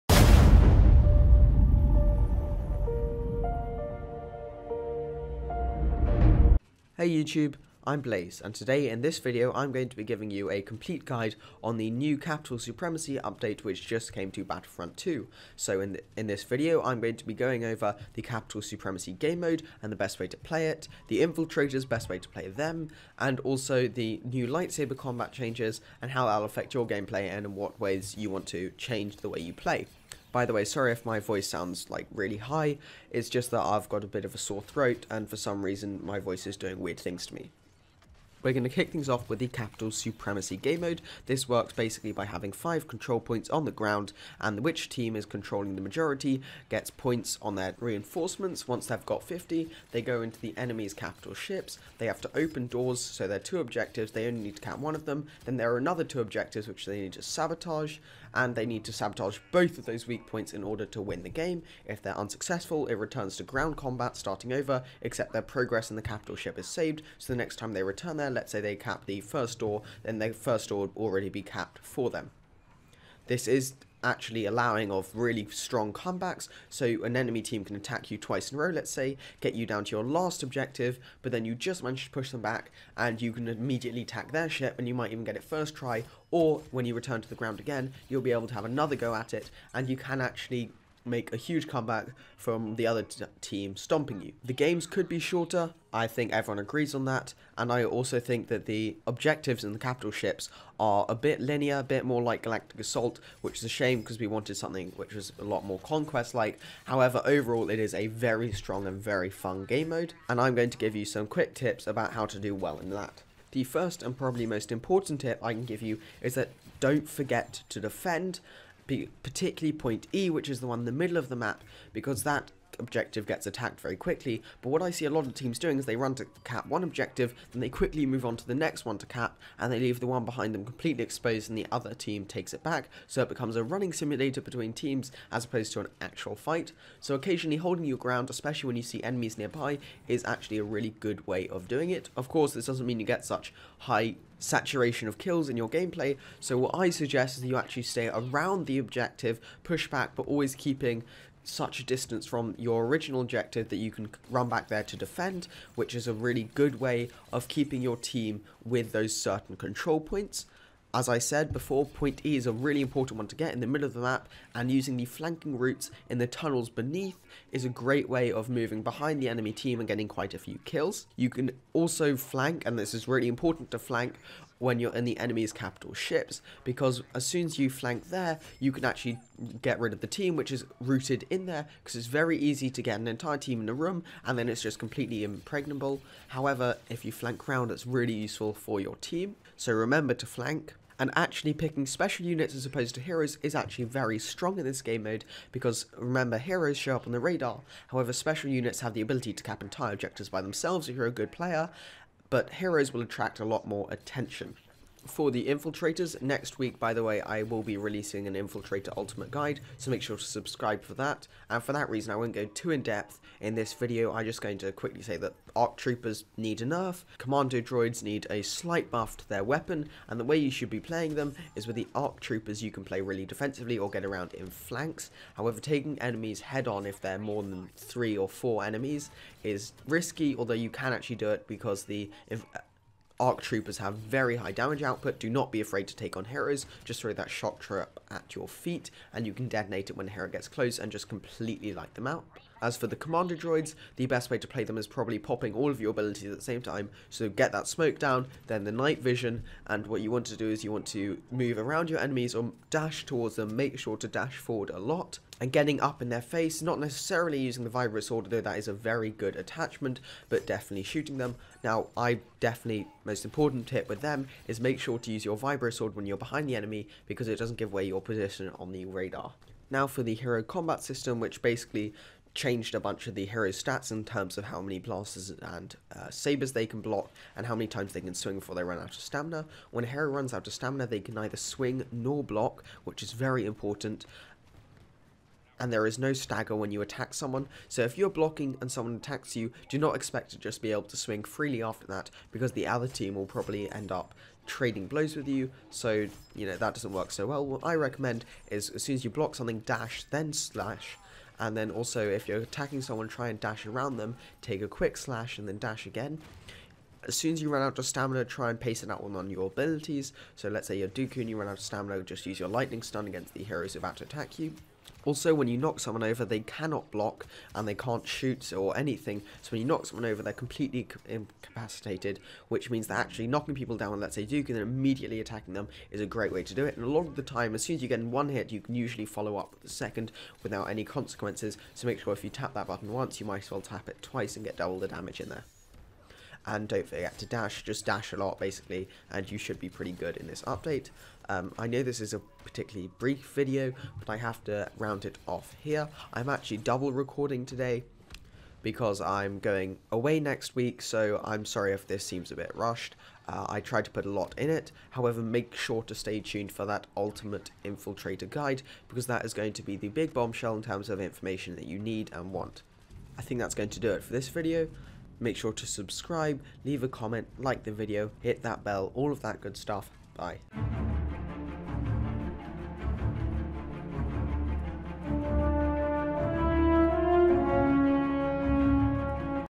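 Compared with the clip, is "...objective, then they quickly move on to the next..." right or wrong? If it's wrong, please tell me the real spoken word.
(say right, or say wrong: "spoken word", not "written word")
right.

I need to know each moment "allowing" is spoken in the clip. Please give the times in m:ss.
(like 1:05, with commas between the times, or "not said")
1:14.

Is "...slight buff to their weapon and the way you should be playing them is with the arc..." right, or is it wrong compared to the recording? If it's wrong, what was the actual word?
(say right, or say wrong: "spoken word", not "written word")
right.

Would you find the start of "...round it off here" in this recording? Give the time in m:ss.
5:44.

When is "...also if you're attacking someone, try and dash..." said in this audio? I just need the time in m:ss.
5:01.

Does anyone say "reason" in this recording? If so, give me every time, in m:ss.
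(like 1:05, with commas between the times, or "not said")
0:35, 3:31.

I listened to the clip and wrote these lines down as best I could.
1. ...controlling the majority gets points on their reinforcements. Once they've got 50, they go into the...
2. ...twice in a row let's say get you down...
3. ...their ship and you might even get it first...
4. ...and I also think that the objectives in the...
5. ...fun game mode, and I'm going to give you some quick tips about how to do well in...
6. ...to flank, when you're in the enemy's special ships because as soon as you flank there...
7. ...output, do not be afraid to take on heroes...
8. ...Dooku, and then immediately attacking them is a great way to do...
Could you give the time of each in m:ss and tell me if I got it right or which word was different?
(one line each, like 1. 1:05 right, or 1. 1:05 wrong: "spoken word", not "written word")
1. 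0:45 right
2. 1:18 right
3. 1:24 right
4. 1:37 right
5. 1:49 right
6. 2:53 wrong: "capital", not "special"
7. 3:54 right
8. 5:24 right.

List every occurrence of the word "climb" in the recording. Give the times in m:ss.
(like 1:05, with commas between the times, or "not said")
not said.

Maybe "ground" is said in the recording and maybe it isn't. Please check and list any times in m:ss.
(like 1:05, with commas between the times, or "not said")
0:43, 1:03, 1:27, 2:17.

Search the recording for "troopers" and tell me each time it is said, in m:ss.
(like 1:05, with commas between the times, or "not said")
3:35, 3:42, 3:53.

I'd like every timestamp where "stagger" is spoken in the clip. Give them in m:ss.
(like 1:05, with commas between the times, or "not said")
4:46.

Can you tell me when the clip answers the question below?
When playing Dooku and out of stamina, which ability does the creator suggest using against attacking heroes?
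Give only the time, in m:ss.
5:12.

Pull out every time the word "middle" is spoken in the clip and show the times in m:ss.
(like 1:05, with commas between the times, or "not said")
2:00, 2:43.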